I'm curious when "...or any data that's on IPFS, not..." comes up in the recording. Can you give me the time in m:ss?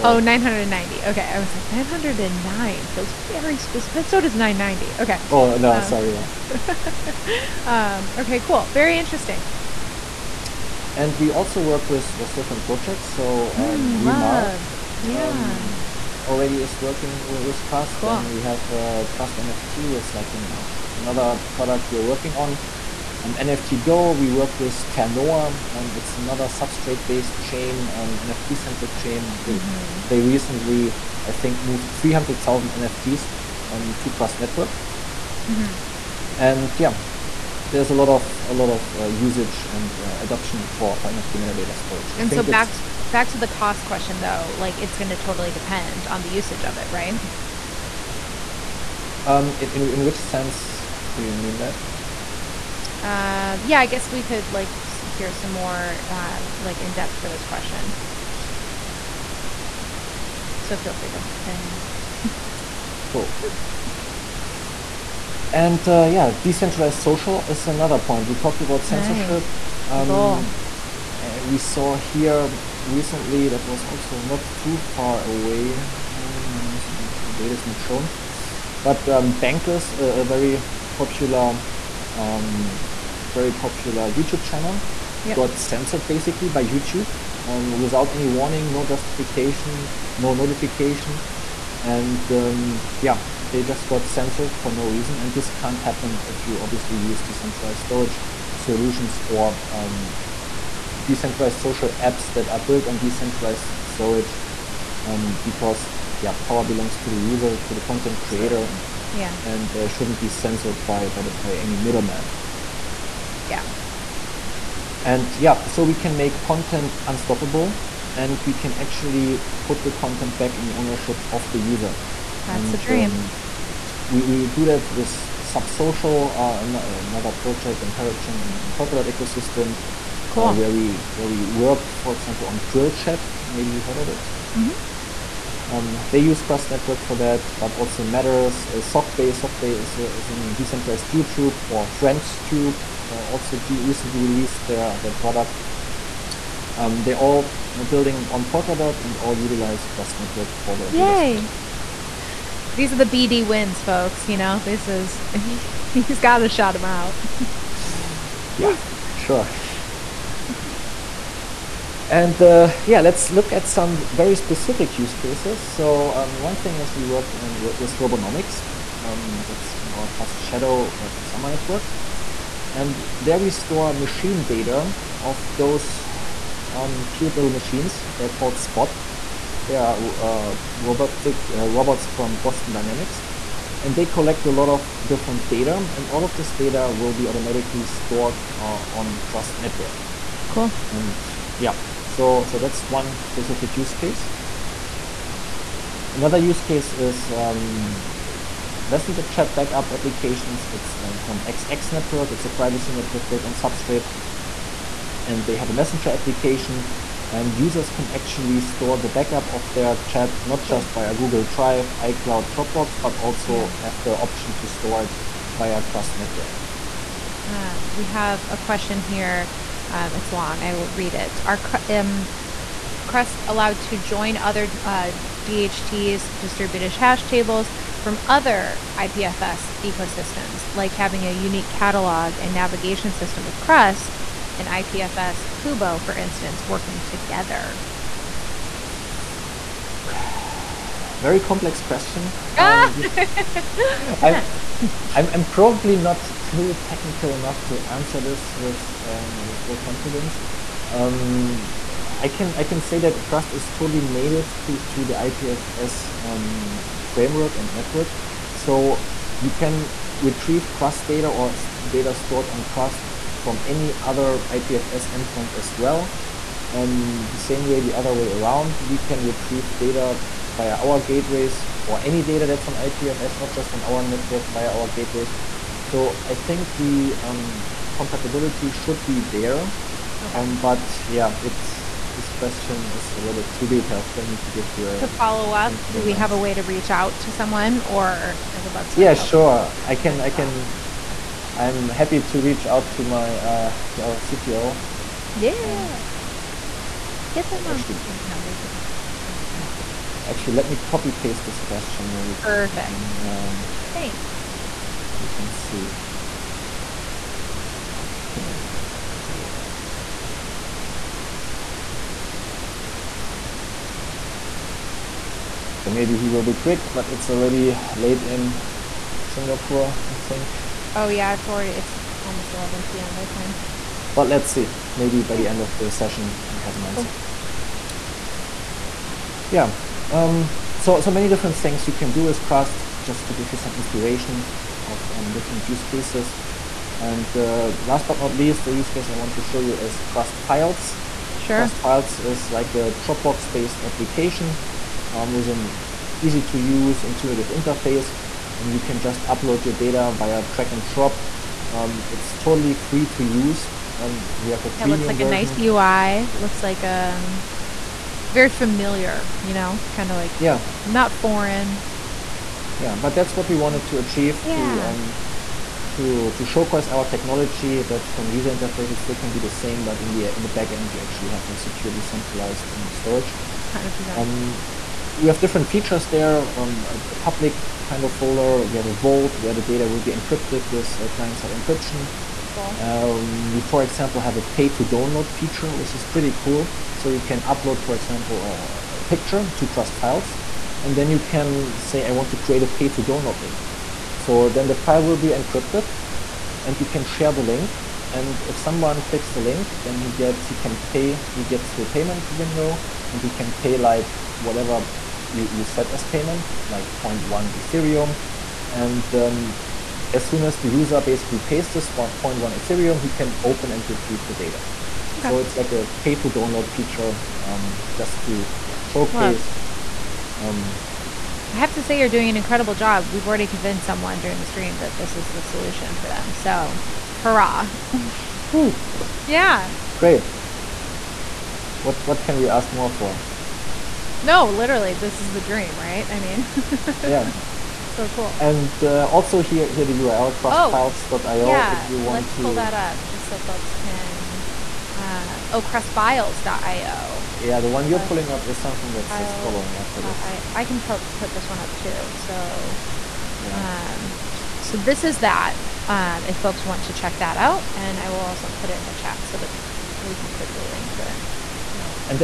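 4:31.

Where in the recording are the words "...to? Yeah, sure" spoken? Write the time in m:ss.
4:48.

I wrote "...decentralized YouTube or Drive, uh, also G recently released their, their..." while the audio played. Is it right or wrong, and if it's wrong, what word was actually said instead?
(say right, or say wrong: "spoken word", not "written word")
wrong: "FriendsTube", not "Drive".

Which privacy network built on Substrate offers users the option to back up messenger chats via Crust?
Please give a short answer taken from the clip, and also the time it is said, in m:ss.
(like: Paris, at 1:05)
XX Network, at 3:21.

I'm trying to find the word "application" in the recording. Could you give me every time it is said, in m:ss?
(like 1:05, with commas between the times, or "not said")
3:19, 3:26, 5:43.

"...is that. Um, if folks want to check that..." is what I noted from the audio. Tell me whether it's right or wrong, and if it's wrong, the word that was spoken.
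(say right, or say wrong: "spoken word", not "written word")
right.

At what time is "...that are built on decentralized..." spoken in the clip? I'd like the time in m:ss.
1:42.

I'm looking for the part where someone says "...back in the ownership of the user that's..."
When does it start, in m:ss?
2:00.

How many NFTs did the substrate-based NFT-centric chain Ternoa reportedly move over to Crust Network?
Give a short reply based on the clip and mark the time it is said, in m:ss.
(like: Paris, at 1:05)
300,000, at 0:31.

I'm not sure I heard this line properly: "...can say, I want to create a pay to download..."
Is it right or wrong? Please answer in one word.
right.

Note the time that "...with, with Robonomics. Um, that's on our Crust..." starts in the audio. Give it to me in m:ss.
2:47.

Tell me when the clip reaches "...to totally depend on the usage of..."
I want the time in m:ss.
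0:45.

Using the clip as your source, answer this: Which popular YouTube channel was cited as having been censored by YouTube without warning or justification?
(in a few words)
Bankless.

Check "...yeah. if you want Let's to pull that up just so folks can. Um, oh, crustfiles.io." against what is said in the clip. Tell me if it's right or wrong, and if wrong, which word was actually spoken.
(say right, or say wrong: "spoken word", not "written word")
right.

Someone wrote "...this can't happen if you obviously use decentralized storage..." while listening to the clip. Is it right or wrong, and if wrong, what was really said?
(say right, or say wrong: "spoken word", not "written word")
right.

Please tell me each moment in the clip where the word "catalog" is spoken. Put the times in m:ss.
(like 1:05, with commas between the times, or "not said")
3:51.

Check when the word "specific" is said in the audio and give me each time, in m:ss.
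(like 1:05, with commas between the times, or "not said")
0:03, 2:44, 3:13.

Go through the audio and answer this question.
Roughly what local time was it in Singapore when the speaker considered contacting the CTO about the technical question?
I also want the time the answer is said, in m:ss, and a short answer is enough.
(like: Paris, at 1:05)
11 p.m., at 5:22.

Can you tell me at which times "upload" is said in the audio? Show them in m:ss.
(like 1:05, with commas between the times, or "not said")
5:49, 6:27.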